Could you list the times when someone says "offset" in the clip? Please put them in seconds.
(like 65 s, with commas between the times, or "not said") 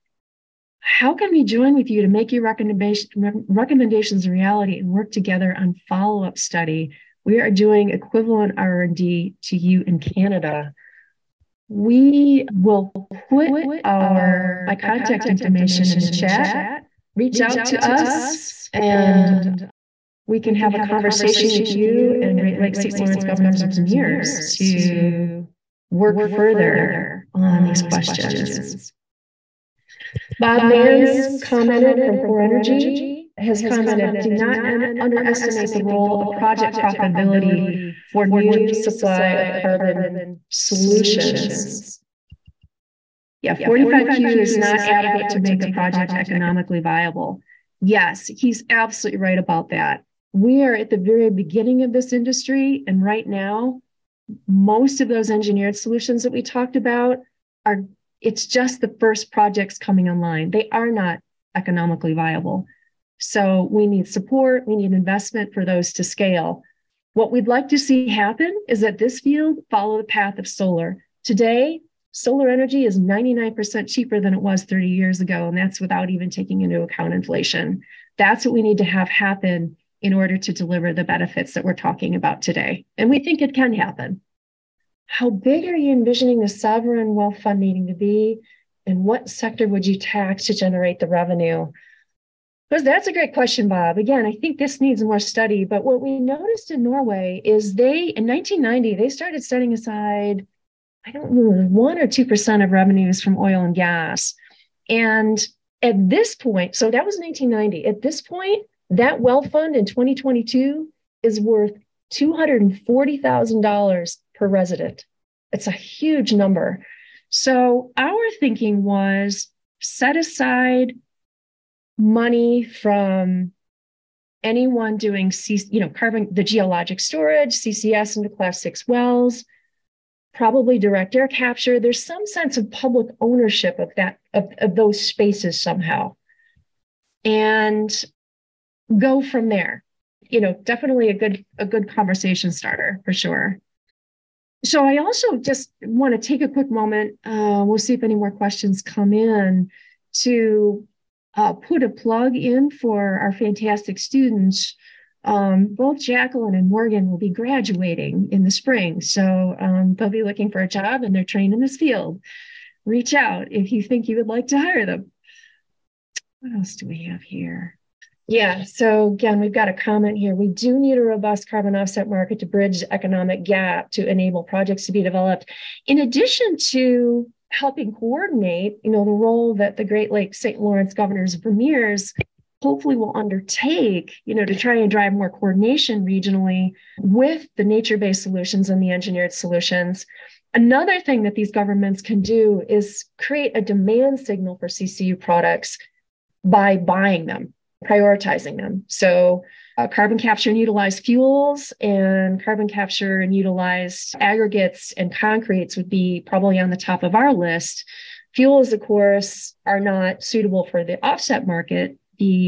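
171 s, 211 s.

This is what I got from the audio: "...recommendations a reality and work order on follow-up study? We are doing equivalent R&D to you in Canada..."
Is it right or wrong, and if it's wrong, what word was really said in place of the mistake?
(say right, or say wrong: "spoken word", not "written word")
wrong: "together", not "order".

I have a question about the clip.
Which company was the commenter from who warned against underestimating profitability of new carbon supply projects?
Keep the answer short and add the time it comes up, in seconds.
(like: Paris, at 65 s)
Core Energy, at 32 s.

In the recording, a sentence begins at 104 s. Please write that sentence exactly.
And at this point, so that was 1990.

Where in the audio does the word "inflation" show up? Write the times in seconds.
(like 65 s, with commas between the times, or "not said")
77 s.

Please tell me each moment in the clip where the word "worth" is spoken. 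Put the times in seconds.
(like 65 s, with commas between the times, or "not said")
111 s.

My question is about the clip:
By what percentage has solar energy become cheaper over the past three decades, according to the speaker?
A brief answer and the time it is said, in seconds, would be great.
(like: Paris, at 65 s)
99%, at 72 s.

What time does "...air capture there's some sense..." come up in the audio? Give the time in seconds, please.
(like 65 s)
131 s.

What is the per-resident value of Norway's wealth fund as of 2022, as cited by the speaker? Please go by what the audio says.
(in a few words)
$240,000.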